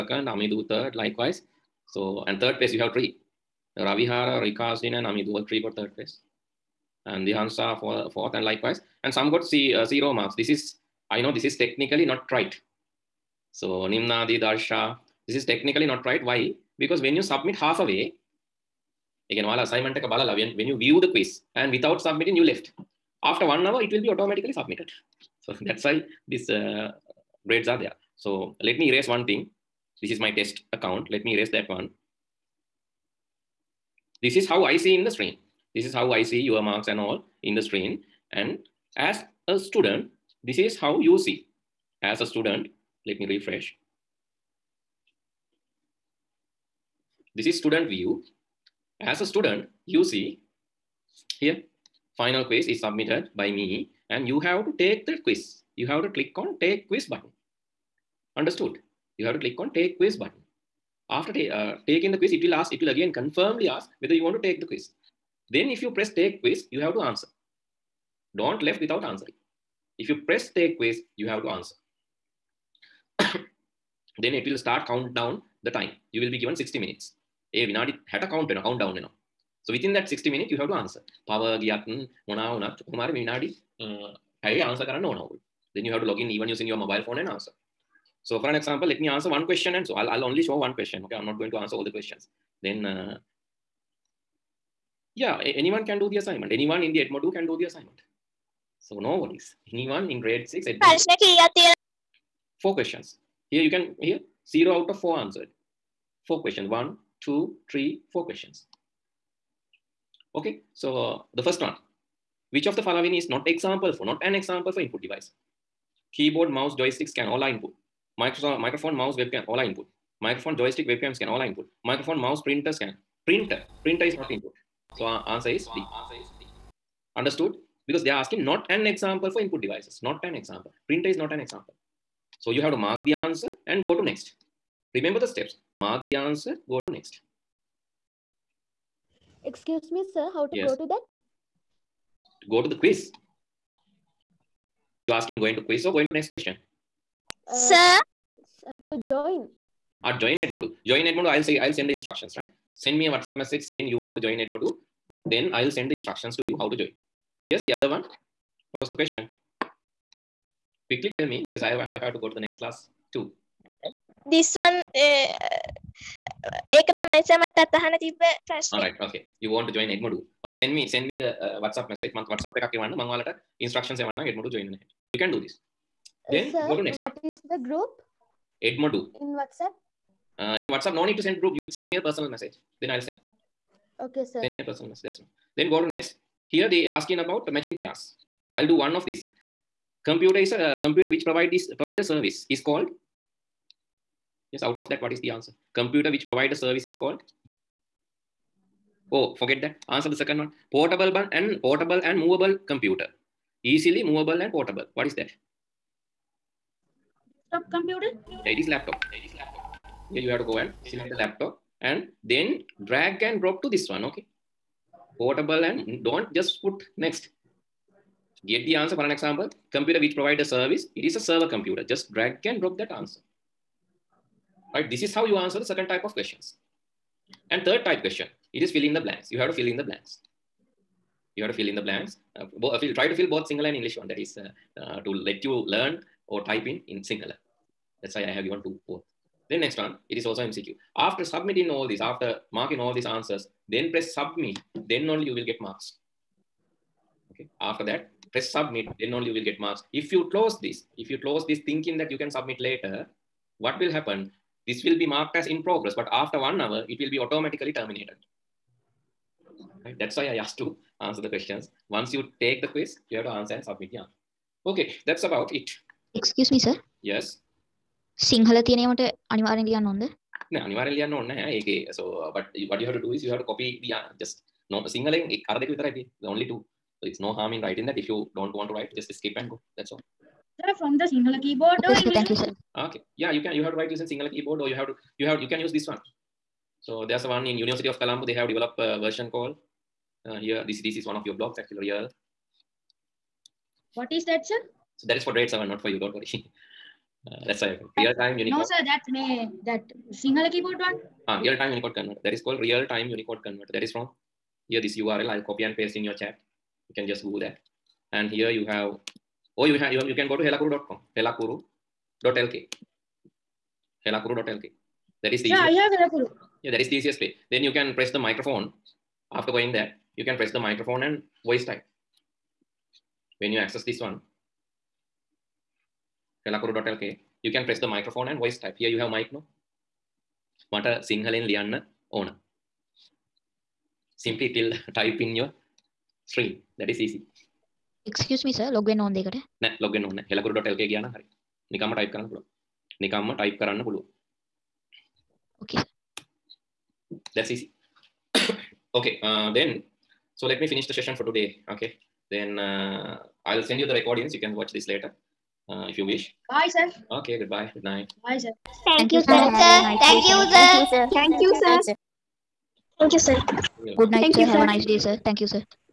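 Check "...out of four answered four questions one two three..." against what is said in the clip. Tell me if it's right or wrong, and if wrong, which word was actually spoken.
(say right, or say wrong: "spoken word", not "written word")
right.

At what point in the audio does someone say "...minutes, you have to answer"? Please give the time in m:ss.
1:20.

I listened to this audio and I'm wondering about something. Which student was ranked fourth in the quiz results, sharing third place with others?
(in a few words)
Dihansa.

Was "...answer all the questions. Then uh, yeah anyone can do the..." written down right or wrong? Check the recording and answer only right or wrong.
right.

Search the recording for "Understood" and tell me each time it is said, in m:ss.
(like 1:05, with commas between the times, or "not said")
0:58, 2:07.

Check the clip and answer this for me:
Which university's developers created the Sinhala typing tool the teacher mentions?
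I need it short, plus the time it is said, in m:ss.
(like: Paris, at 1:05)
University of Colombo, at 4:47.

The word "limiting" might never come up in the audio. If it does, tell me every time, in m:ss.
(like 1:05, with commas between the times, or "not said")
not said.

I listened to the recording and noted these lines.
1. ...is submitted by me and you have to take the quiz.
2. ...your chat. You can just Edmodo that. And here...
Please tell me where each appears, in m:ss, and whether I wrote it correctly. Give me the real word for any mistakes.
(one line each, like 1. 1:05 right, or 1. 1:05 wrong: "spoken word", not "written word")
1. 0:52 right
2. 5:06 wrong: "Google", not "Edmodo".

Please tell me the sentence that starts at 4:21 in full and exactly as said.
Once you take the quiz, you have to answer and submit the answer.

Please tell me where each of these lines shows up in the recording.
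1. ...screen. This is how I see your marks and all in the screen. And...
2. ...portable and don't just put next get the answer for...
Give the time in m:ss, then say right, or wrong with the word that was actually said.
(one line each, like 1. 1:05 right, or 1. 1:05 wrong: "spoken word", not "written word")
1. 0:35 right
2. 3:35 right.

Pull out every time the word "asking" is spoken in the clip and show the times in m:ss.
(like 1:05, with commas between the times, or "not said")
2:08, 2:25, 3:06.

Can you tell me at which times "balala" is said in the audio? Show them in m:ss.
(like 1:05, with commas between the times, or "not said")
0:19.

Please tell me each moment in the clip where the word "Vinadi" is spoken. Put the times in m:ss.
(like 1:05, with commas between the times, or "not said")
1:17, 1:23.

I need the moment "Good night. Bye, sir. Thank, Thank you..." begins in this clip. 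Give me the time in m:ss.
5:57.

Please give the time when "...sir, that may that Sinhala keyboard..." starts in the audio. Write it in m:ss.
4:58.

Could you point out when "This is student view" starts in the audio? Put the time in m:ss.
0:47.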